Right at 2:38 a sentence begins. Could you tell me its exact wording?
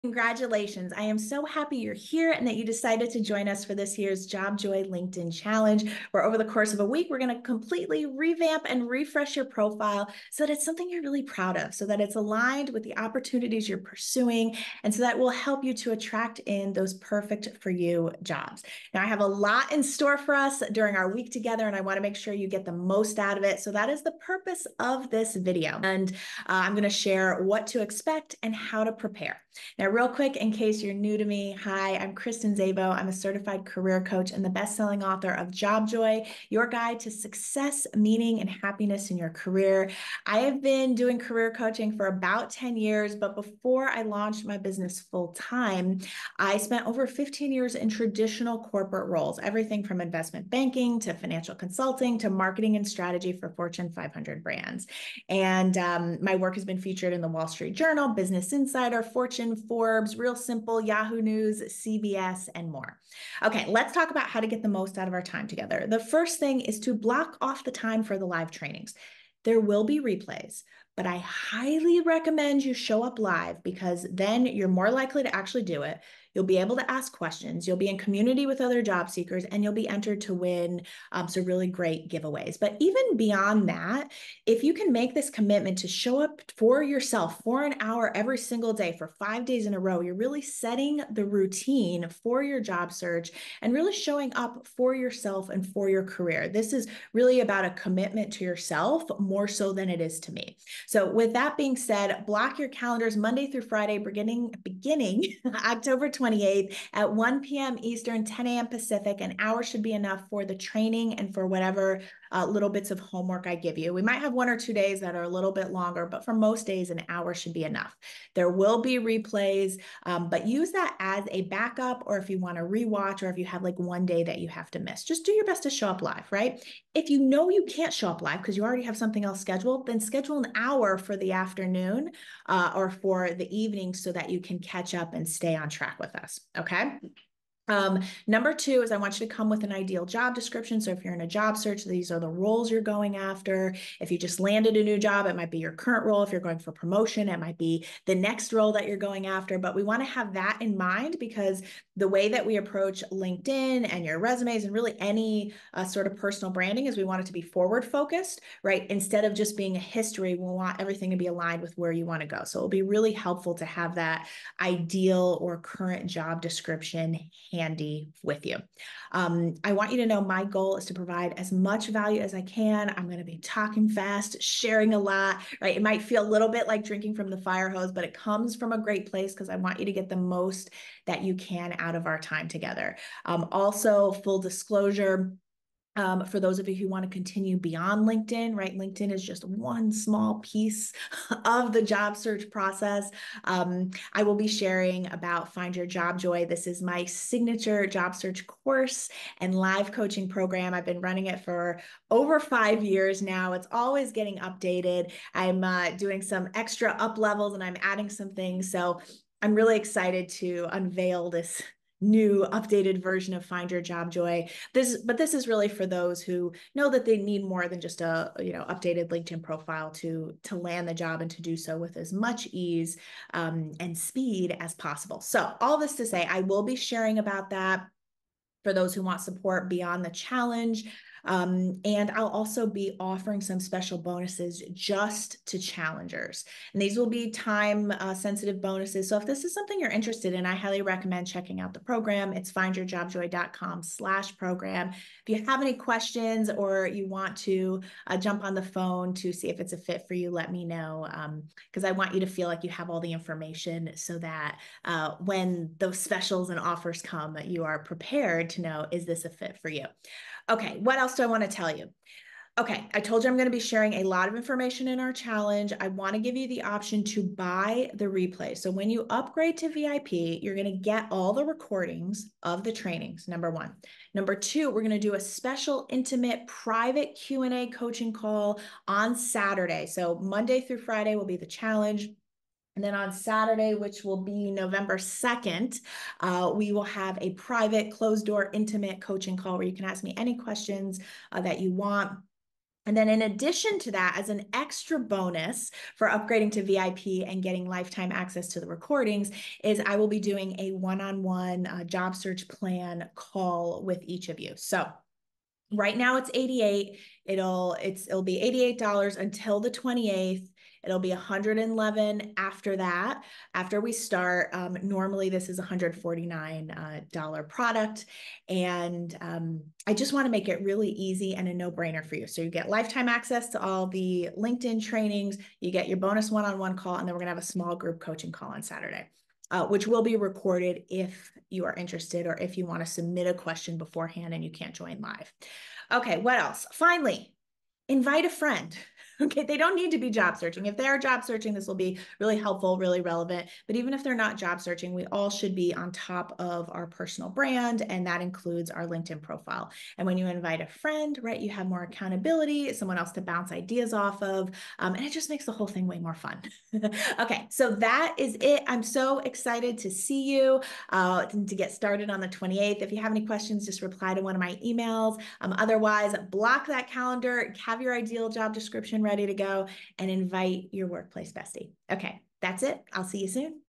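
Instead of just being a history, we want everything to be aligned with where you want to go.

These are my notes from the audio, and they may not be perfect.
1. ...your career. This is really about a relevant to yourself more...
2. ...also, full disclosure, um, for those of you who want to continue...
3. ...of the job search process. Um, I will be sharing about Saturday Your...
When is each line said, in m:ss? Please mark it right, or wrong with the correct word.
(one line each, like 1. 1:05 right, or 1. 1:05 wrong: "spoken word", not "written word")
1. 1:35 wrong: "commitment", not "relevant"
2. 3:03 right
3. 3:11 wrong: "Find", not "Saturday".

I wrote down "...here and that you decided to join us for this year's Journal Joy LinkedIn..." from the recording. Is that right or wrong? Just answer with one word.
wrong.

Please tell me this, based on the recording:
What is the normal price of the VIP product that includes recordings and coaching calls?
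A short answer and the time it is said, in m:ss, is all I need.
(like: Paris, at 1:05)
$149, at 5:15.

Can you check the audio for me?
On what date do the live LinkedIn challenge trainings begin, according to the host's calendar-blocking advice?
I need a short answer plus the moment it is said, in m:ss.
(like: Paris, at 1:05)
October 28th, at 1:45.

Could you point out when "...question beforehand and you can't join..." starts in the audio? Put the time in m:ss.
5:33.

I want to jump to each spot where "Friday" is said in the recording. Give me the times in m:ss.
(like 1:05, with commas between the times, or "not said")
1:43, 4:40.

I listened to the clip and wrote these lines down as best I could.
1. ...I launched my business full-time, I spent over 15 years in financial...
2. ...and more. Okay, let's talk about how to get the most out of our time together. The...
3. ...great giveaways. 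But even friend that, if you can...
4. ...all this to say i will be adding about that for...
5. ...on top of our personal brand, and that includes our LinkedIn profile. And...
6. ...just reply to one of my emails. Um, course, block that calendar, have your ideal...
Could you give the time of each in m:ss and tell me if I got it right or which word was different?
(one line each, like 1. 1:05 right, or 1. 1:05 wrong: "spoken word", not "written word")
1. 0:43 wrong: "traditional", not "financial"
2. 1:02 right
3. 1:21 wrong: "beyond", not "friend"
4. 3:45 wrong: "sharing", not "adding"
5. 5:45 right
6. 6:03 wrong: "otherwise", not "course".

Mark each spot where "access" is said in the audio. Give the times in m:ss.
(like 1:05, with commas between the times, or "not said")
4:58, 5:23.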